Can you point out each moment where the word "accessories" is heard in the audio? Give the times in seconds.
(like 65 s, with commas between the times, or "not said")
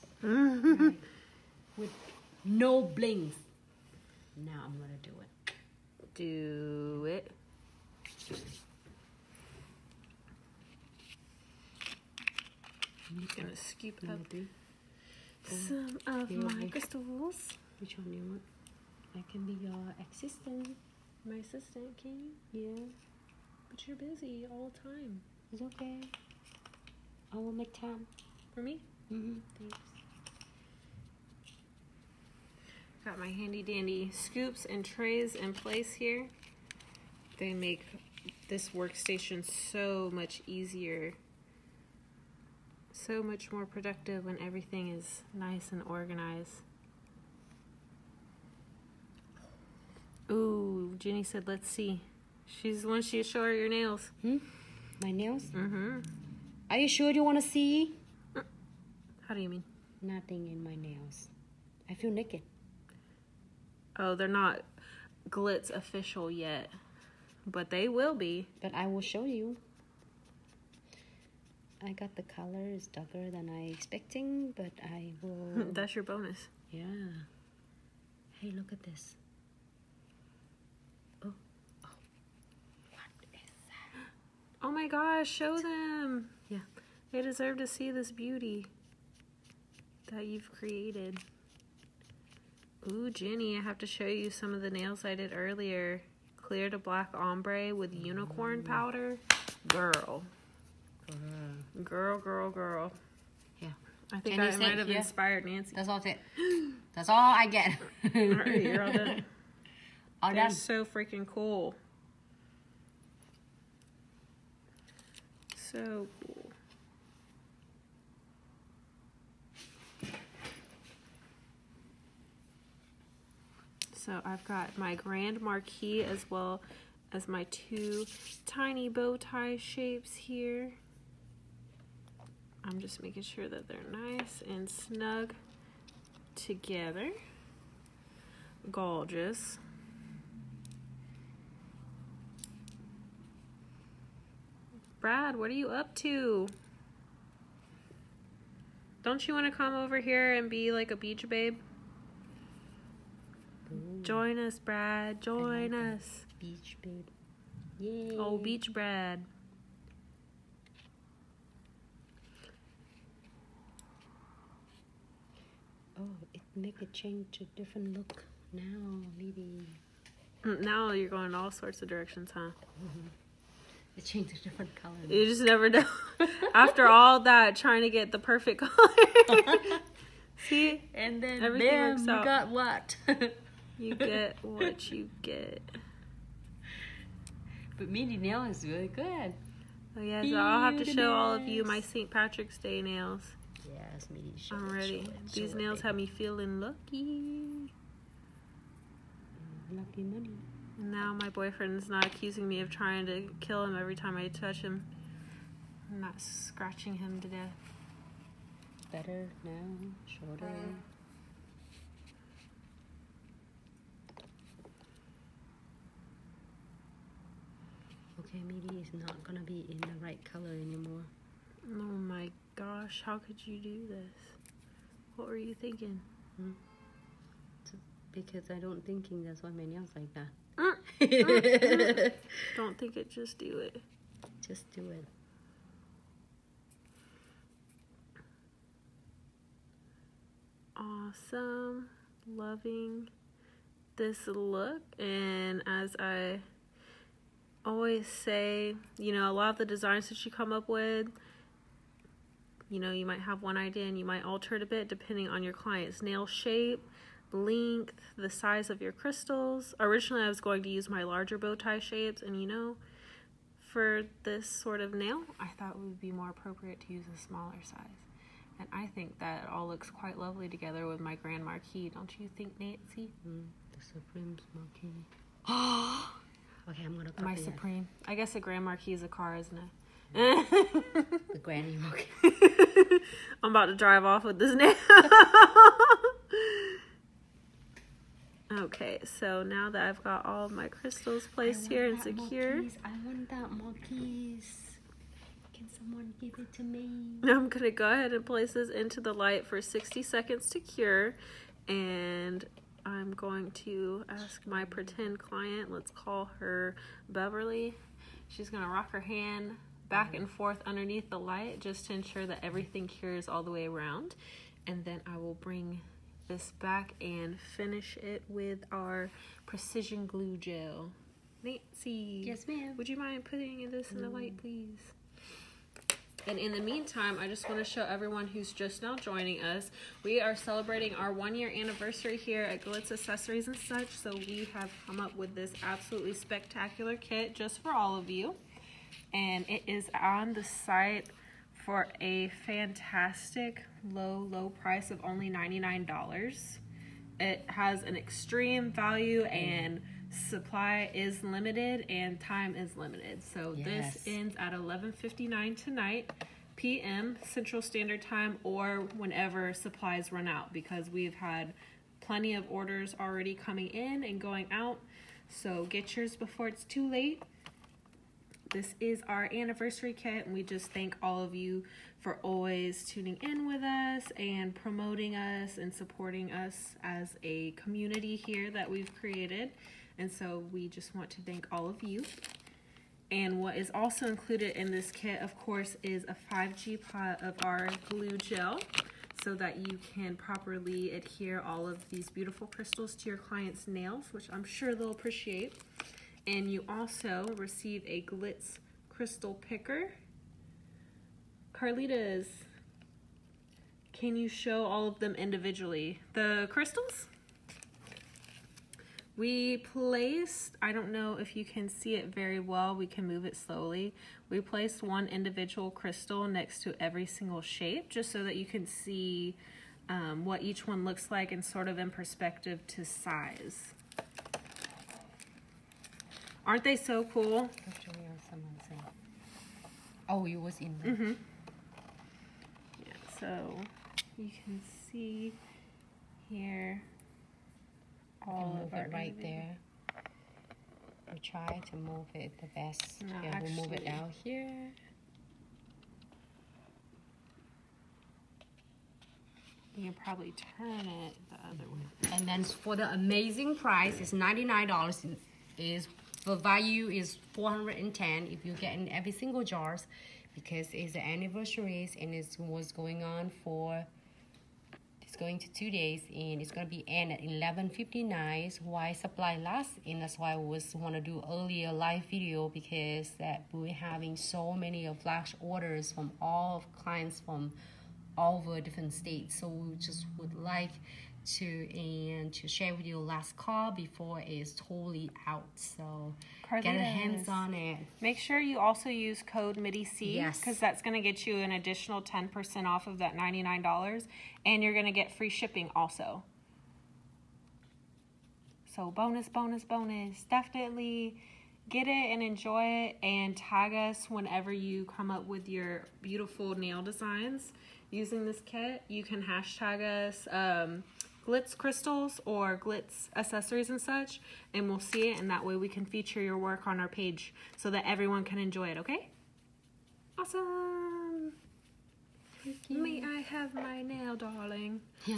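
332 s, 513 s.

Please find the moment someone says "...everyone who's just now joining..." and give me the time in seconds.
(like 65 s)
327 s.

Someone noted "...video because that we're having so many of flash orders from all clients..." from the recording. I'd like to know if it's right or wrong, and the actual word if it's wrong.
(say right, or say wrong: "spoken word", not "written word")
right.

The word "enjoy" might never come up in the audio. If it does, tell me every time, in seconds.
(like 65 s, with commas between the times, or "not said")
502 s, 518 s.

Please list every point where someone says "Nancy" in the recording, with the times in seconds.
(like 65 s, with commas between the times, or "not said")
105 s, 272 s, 321 s.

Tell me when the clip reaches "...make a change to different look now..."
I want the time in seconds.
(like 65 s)
166 s.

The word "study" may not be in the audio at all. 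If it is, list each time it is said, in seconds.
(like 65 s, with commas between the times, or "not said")
not said.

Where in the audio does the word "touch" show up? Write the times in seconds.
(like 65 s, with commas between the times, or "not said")
204 s.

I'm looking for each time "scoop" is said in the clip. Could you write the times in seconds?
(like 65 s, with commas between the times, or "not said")
13 s, 34 s.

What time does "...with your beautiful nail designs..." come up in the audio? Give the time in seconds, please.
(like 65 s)
505 s.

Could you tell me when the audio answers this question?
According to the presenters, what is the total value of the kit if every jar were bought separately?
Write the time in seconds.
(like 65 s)
457 s.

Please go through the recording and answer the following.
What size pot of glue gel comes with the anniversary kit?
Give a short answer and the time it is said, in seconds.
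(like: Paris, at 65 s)
5G, at 386 s.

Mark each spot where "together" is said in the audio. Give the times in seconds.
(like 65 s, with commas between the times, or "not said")
136 s, 270 s.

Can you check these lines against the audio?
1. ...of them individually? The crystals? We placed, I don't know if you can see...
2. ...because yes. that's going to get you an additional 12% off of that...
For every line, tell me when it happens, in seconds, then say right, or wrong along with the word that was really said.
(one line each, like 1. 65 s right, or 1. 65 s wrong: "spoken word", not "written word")
1. 404 s right
2. 490 s wrong: "10", not "12".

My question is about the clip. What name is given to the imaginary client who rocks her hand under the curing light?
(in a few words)
Beverly.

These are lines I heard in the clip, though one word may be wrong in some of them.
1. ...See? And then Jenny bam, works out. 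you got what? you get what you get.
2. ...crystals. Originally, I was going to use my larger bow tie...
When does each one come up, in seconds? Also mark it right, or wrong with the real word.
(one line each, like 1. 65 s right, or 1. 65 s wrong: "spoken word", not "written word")
1. 180 s wrong: "Everything", not "Jenny"
2. 258 s right.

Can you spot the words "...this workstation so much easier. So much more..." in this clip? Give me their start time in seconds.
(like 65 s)
38 s.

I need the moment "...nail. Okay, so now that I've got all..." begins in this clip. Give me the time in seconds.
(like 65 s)
284 s.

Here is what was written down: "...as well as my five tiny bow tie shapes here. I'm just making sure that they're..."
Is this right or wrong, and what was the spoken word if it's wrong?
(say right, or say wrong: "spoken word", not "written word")
wrong: "two", not "five".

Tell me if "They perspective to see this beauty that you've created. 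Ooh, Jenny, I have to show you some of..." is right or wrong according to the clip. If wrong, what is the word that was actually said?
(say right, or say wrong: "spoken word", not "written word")
wrong: "deserve", not "perspective".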